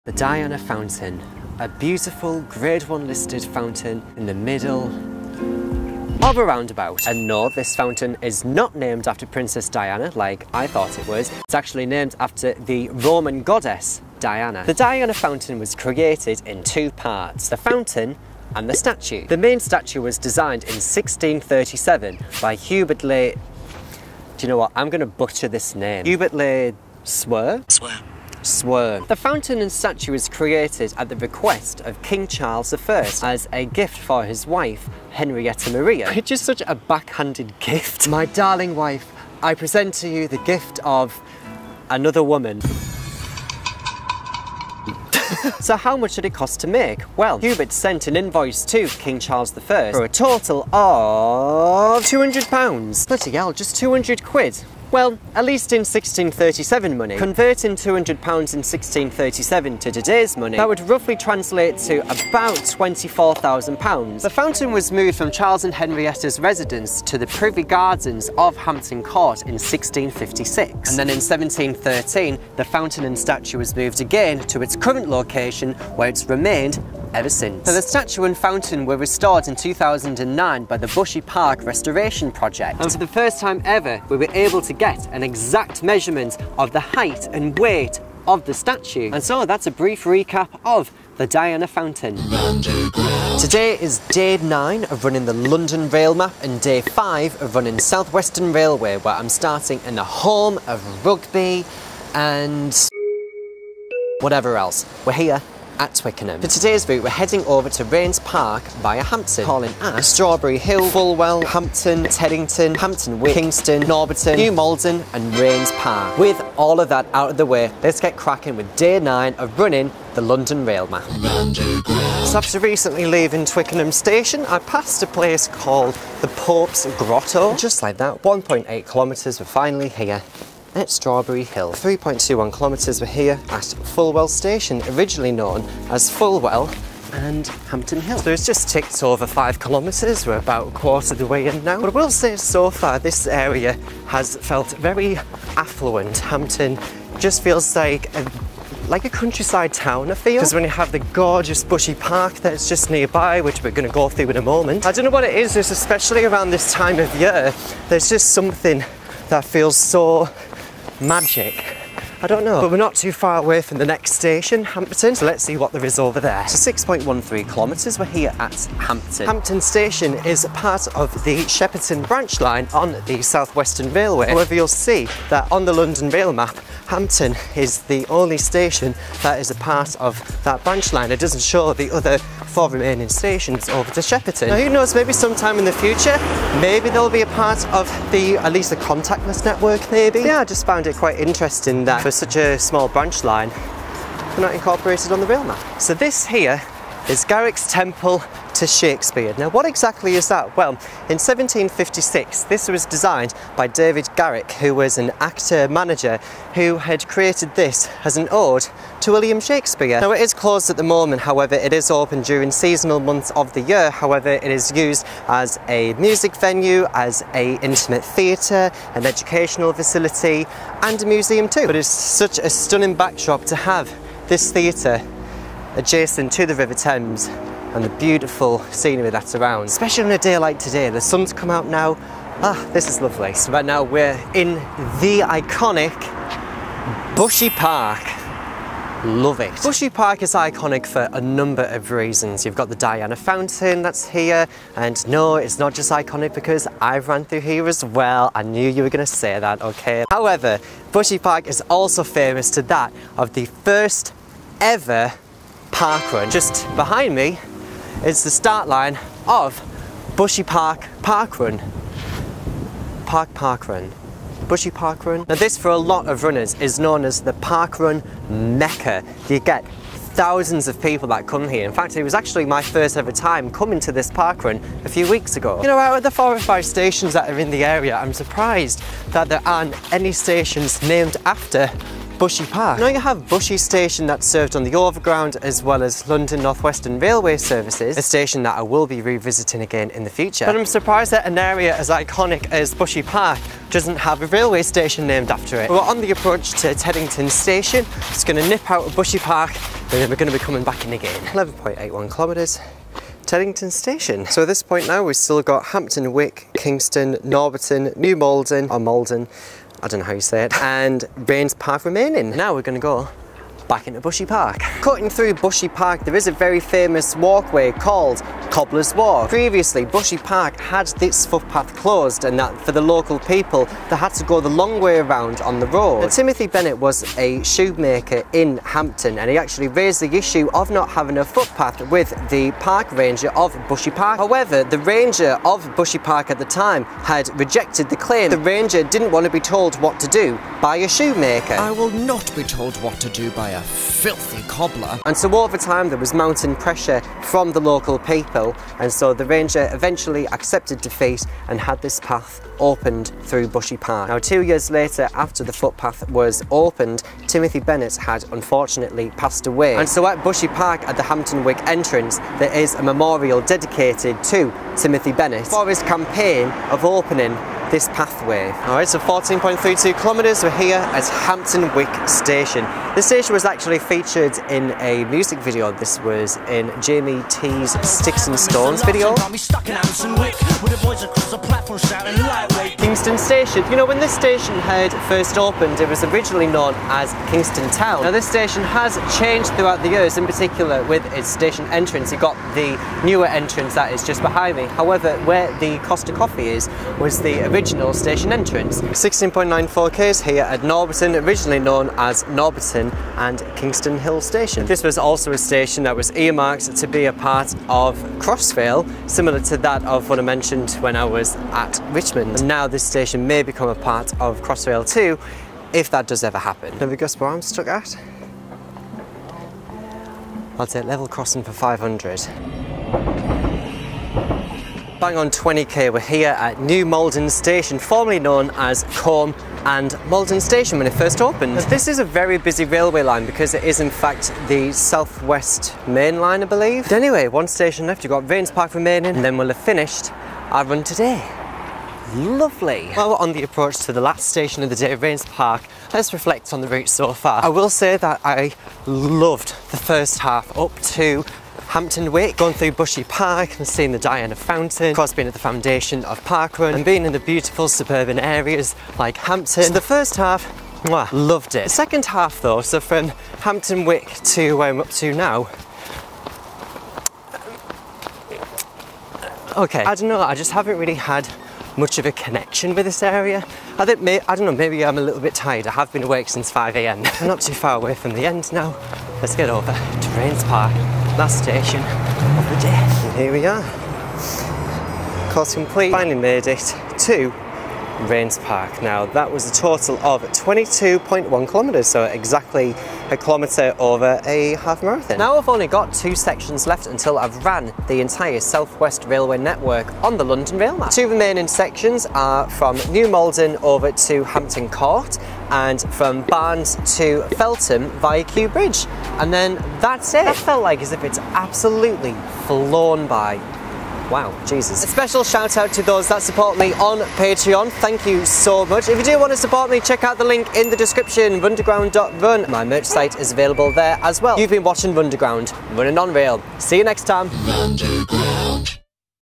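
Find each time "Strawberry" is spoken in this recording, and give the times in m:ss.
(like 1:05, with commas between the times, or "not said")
1:50, 2:10.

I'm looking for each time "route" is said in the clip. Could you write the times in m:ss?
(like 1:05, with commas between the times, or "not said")
1:46, 7:26.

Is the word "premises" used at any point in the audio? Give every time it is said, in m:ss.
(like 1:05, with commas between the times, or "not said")
not said.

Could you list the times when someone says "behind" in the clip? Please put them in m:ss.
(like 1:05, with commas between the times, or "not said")
4:16, 6:34.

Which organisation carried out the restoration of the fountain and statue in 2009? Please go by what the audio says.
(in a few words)
Bushy Park Restoration Project.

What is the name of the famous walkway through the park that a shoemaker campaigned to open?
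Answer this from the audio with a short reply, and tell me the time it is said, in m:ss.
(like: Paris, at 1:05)
Cobbler's Walk, at 5:18.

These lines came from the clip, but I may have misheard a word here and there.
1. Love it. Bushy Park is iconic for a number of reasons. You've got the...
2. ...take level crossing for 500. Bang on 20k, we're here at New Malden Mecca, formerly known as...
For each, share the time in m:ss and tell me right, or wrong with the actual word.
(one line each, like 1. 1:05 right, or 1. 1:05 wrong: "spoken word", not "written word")
1. 3:59 right
2. 7:00 wrong: "Station", not "Mecca".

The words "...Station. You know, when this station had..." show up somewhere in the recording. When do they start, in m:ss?
6:23.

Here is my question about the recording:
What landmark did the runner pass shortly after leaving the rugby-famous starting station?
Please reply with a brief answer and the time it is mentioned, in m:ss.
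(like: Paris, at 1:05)
Pope's Grotto, at 2:06.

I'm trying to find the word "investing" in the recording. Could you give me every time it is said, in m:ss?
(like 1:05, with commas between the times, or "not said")
not said.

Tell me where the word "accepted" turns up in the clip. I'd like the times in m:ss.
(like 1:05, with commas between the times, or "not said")
5:50.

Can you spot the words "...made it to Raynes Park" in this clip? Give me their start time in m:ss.
8:06.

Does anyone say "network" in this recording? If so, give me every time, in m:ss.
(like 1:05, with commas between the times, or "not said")
3:09, 8:19.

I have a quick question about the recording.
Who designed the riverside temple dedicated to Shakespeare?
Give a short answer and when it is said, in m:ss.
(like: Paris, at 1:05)
David Garrick, at 3:23.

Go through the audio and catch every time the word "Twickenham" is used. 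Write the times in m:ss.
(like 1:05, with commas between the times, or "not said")
1:45, 2:03.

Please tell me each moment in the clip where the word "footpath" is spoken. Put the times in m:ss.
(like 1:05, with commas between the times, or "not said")
5:21, 5:31, 5:55.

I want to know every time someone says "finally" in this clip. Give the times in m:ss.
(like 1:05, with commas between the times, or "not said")
2:09, 8:05.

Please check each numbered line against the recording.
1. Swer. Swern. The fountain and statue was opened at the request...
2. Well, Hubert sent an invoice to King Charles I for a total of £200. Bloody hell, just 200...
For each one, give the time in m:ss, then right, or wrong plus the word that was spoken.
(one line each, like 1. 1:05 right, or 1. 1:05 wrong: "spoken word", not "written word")
1. 0:27 wrong: "created", not "opened"
2. 0:47 right.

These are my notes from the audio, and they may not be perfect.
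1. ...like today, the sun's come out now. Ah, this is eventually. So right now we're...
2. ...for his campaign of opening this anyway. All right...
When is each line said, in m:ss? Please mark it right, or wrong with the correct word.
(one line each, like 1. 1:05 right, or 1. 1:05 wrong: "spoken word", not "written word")
1. 3:50 wrong: "lovely", not "eventually"
2. 6:05 wrong: "pathway", not "anyway".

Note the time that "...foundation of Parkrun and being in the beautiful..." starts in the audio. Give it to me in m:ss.
7:35.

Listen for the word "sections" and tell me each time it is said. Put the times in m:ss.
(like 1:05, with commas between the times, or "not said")
8:16, 8:21.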